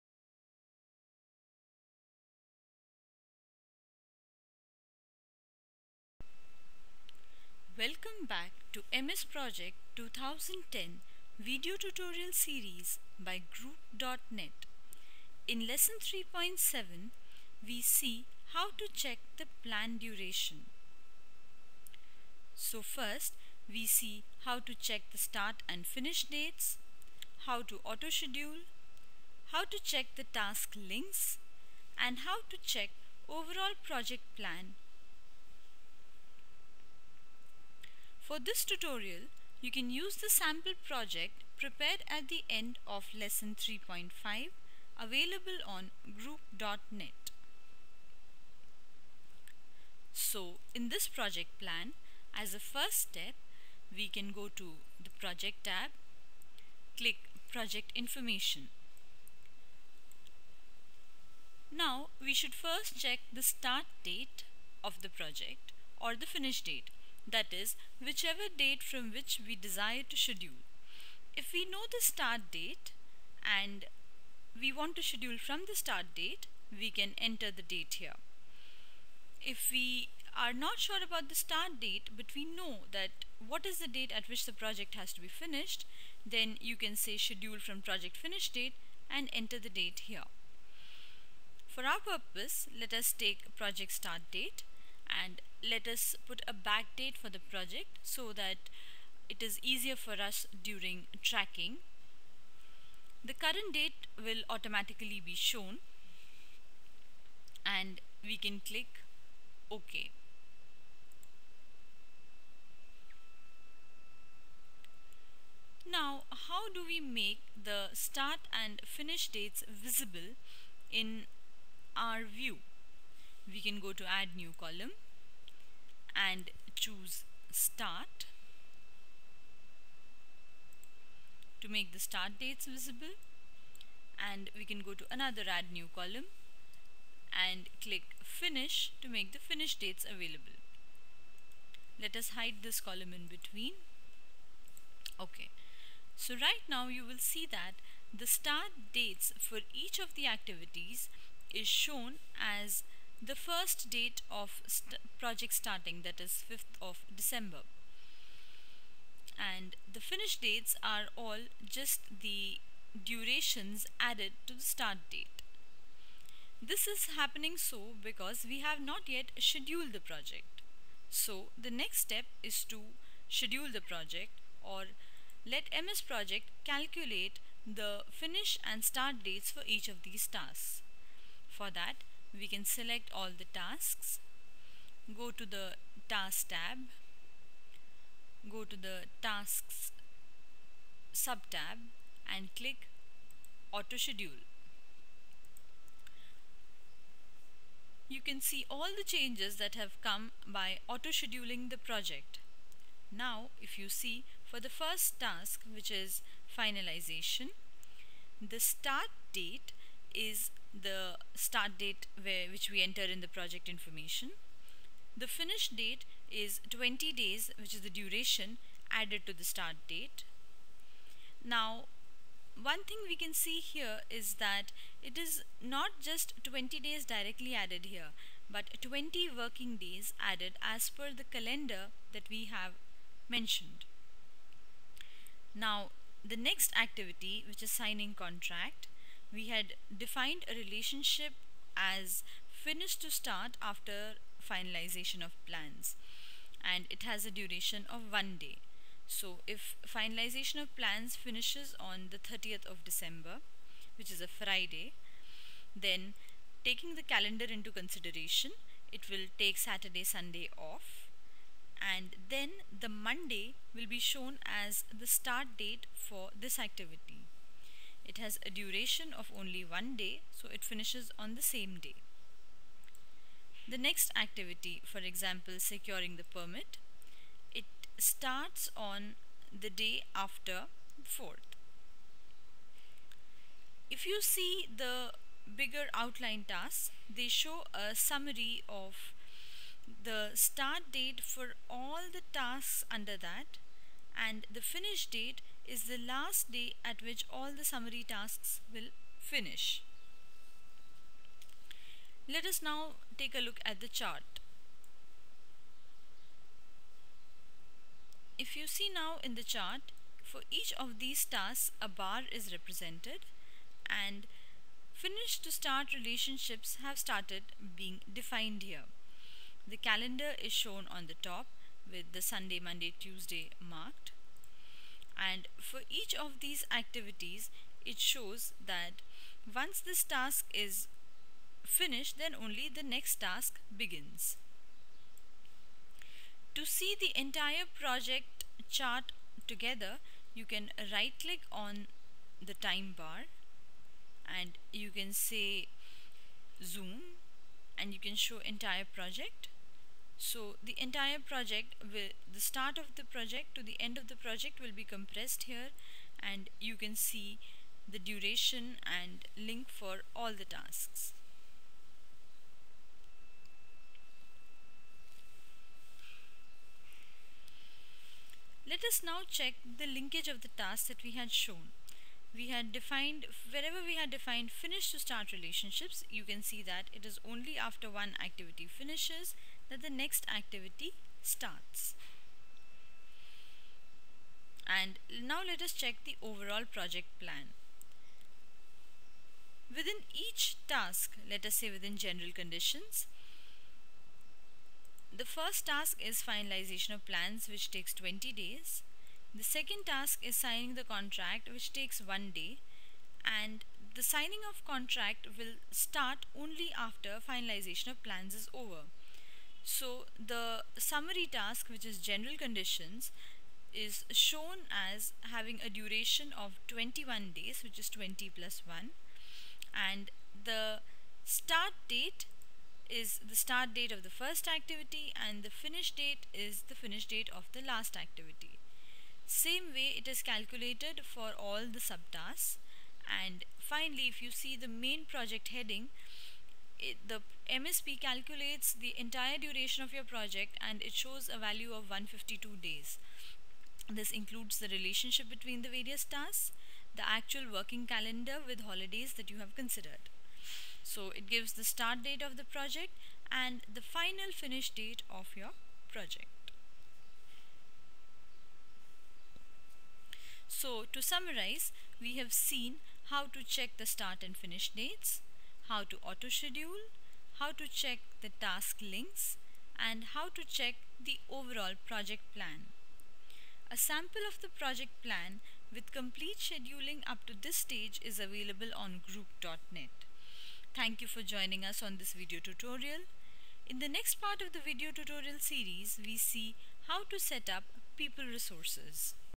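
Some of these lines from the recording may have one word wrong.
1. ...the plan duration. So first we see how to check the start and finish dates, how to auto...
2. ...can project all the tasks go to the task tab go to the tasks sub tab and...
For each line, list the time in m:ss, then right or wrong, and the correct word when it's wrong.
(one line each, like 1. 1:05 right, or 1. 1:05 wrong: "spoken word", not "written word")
1. 0:19 right
2. 3:02 wrong: "select", not "project".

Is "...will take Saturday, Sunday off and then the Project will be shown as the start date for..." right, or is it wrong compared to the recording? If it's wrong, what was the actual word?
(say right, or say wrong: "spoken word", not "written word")
wrong: "Monday", not "Project".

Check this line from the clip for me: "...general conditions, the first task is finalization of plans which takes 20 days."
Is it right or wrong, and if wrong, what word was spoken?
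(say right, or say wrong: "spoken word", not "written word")
right.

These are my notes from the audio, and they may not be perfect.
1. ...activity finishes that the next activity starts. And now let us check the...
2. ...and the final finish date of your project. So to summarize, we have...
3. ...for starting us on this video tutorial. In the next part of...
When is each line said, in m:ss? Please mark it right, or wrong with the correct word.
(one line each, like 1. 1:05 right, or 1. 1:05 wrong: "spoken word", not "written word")
1. 6:18 right
2. 7:33 right
3. 8:01 wrong: "joining", not "starting".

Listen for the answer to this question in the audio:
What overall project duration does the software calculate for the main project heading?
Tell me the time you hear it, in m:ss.
7:21.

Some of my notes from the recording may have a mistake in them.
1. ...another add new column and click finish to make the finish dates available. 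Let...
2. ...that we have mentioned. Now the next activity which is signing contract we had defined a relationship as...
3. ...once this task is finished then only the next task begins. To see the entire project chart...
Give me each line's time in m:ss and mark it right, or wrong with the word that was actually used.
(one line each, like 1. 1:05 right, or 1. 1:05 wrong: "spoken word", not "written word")
1. 2:15 right
2. 3:52 right
3. 5:29 right.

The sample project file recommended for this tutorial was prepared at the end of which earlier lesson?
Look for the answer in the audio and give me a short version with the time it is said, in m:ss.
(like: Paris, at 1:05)
3.5, at 0:43.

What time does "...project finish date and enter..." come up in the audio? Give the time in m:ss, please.
1:27.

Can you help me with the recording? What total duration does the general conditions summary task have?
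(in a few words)
21 days.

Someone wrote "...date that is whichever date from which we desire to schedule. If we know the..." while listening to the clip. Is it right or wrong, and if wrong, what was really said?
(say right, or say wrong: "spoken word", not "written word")
right.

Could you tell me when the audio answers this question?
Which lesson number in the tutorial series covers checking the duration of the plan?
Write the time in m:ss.
0:15.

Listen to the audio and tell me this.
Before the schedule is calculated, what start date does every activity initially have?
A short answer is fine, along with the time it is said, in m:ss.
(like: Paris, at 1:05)
5th of December, at 2:36.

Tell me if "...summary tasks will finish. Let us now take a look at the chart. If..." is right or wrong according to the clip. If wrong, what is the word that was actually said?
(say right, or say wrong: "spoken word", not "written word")
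right.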